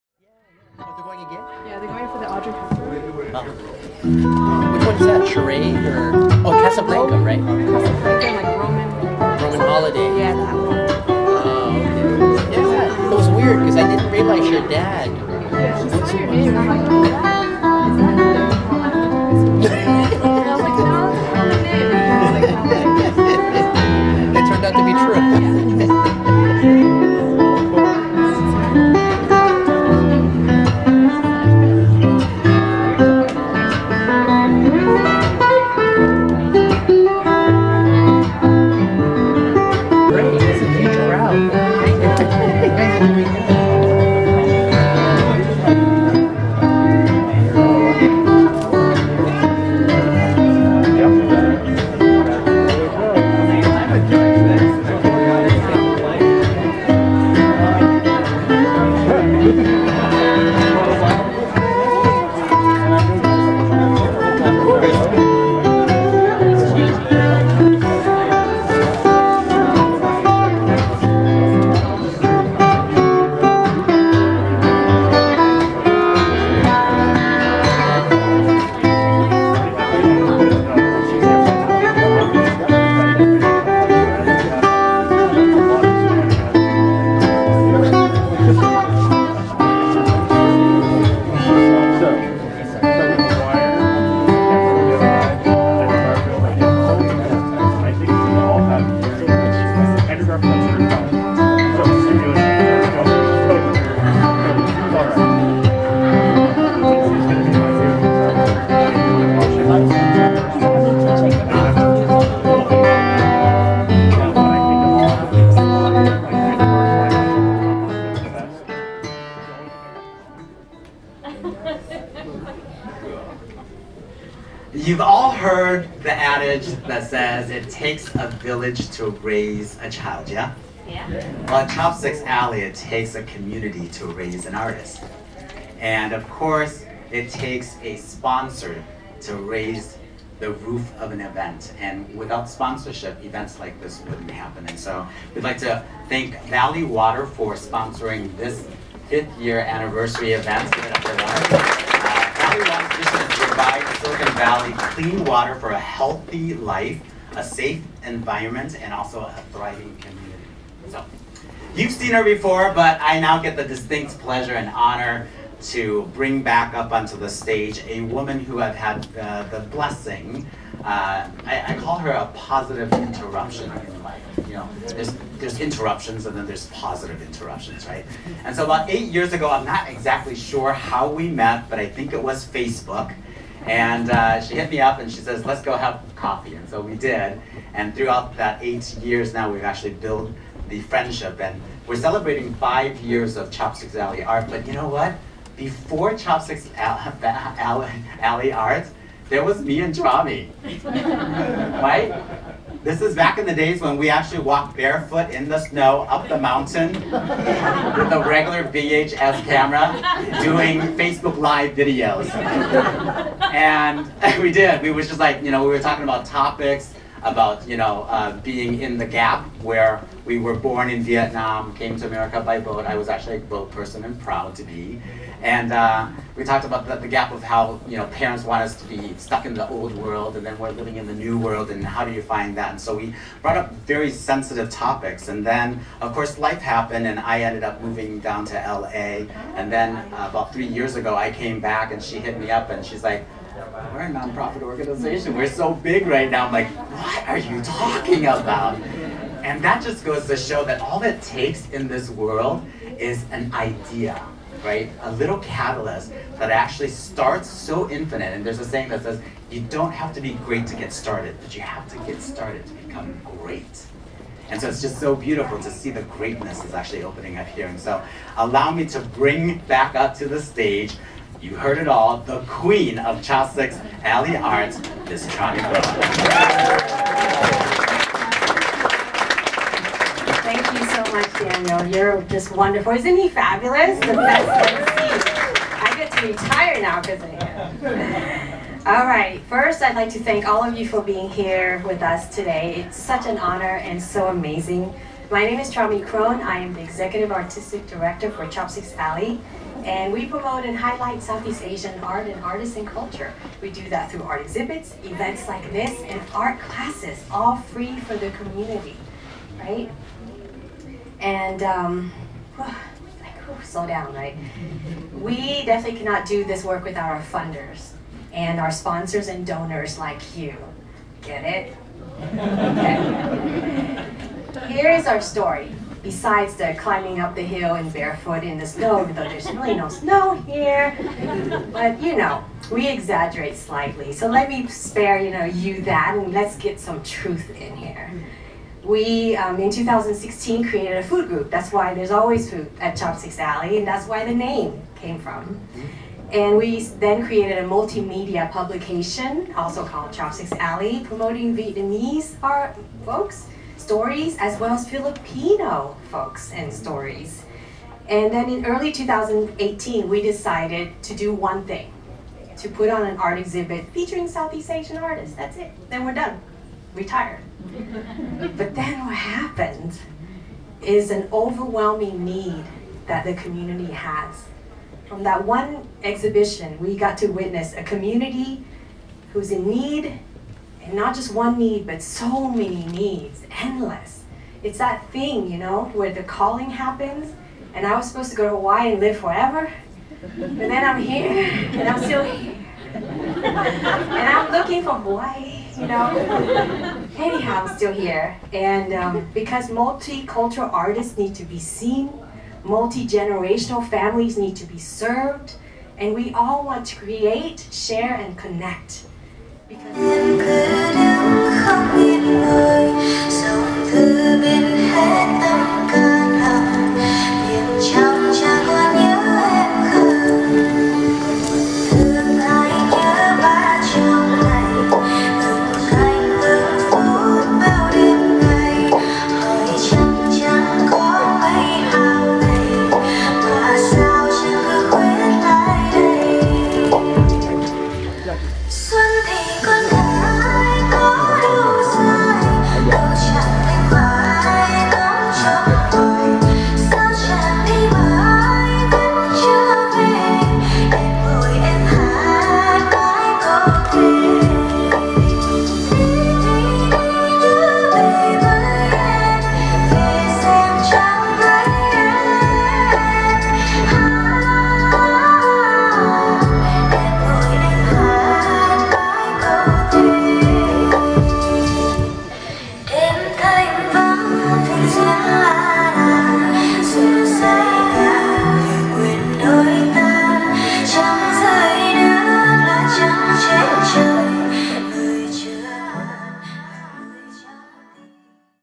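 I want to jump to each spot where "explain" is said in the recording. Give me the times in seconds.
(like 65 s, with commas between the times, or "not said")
not said.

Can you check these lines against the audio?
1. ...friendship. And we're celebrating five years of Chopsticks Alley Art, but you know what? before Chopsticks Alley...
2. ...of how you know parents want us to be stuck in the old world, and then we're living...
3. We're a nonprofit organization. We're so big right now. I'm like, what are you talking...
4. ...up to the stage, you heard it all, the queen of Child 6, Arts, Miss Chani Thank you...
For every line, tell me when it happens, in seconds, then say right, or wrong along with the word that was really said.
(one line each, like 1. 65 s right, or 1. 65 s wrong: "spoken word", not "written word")
1. 190 s right
2. 227 s right
3. 243 s right
4. 269 s right.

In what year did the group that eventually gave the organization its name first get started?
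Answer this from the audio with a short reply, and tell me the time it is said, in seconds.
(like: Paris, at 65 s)
2016, at 339 s.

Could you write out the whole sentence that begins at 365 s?
That's it, then we're done retired.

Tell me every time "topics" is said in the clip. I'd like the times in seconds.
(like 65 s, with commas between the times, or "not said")
216 s, 234 s.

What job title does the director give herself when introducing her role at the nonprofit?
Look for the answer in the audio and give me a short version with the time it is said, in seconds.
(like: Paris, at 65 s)
Executive Artistic Director, at 296 s.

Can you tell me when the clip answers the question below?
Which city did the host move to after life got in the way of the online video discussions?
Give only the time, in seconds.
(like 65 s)
238 s.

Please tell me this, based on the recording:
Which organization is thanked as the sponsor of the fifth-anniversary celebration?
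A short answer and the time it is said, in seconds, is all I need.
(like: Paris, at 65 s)
Valley Water, at 146 s.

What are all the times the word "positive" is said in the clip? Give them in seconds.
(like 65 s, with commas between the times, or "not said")
172 s, 176 s.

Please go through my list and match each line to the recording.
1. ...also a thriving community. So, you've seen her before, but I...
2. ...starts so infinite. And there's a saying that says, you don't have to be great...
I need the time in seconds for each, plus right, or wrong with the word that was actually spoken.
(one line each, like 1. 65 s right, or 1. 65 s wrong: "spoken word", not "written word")
1. 158 s right
2. 256 s right.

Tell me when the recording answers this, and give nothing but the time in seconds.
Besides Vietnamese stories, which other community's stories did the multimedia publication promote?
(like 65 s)
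354 s.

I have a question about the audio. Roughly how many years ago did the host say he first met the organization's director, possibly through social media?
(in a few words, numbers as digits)
8.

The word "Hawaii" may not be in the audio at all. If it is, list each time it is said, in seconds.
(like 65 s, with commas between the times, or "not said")
388 s, 394 s.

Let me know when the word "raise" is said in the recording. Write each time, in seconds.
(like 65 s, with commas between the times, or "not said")
129 s, 134 s, 139 s.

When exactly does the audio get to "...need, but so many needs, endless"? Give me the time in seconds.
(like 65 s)
381 s.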